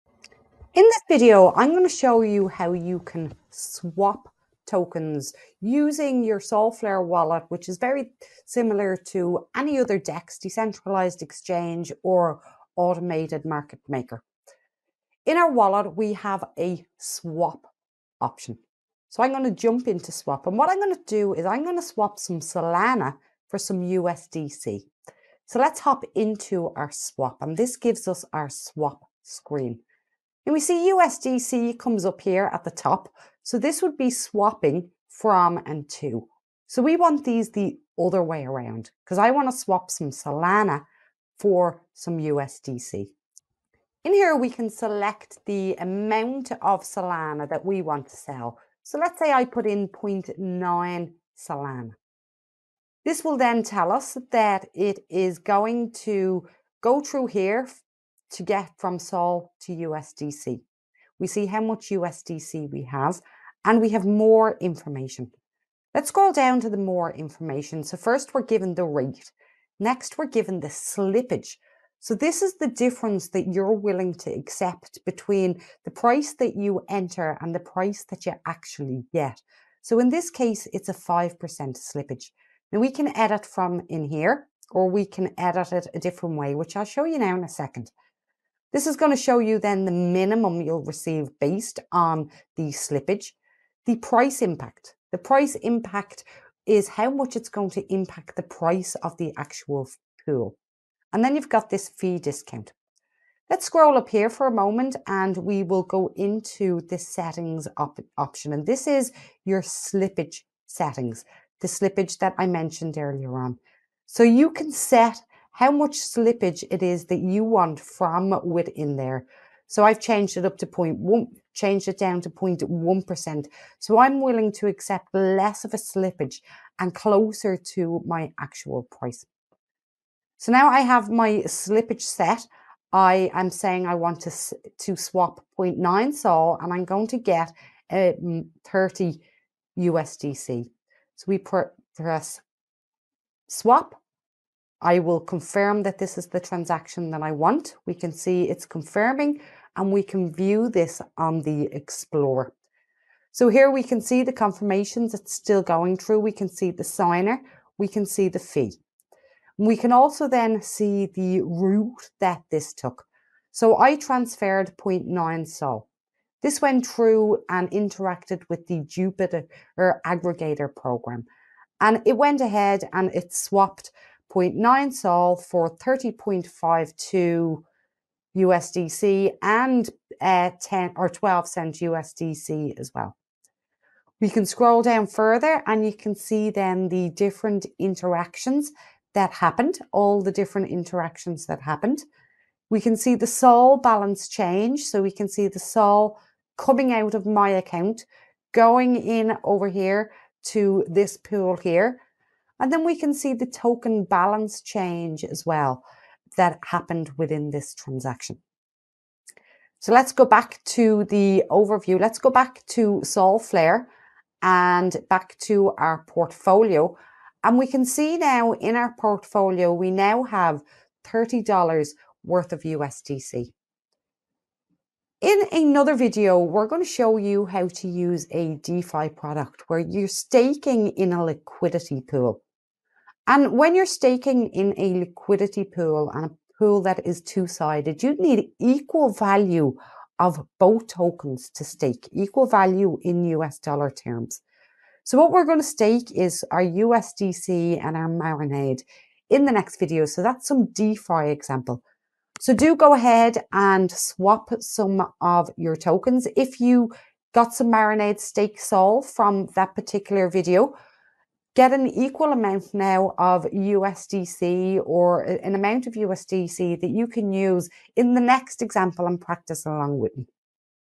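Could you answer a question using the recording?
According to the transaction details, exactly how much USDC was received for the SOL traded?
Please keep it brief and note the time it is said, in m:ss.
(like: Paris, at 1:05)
30.52, at 2:55.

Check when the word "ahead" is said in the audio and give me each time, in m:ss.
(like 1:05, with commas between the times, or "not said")
2:52, 4:12.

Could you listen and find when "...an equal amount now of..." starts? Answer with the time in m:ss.
4:21.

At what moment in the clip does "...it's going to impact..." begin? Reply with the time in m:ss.
1:37.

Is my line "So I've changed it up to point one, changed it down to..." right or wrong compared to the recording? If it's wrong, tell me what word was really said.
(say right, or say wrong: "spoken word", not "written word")
right.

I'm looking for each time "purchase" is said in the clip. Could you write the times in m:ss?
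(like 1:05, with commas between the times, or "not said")
not said.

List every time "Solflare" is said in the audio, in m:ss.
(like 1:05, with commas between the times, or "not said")
0:06, 3:33.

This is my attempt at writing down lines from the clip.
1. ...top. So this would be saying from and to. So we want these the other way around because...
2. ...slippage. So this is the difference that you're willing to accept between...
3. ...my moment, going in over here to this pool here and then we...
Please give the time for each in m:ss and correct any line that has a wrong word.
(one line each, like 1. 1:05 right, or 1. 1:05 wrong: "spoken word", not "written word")
1. 0:32 wrong: "swapping", not "saying"
2. 1:10 right
3. 3:17 wrong: "account", not "moment".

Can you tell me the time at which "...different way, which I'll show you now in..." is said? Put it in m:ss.
1:25.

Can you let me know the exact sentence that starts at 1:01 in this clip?
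We see how much USDC we have, and we have more information.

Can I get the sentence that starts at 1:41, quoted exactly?
And then you've got this fee discount.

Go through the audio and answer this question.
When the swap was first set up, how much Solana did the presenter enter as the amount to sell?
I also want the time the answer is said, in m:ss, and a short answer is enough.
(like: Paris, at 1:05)
0.9, at 0:49.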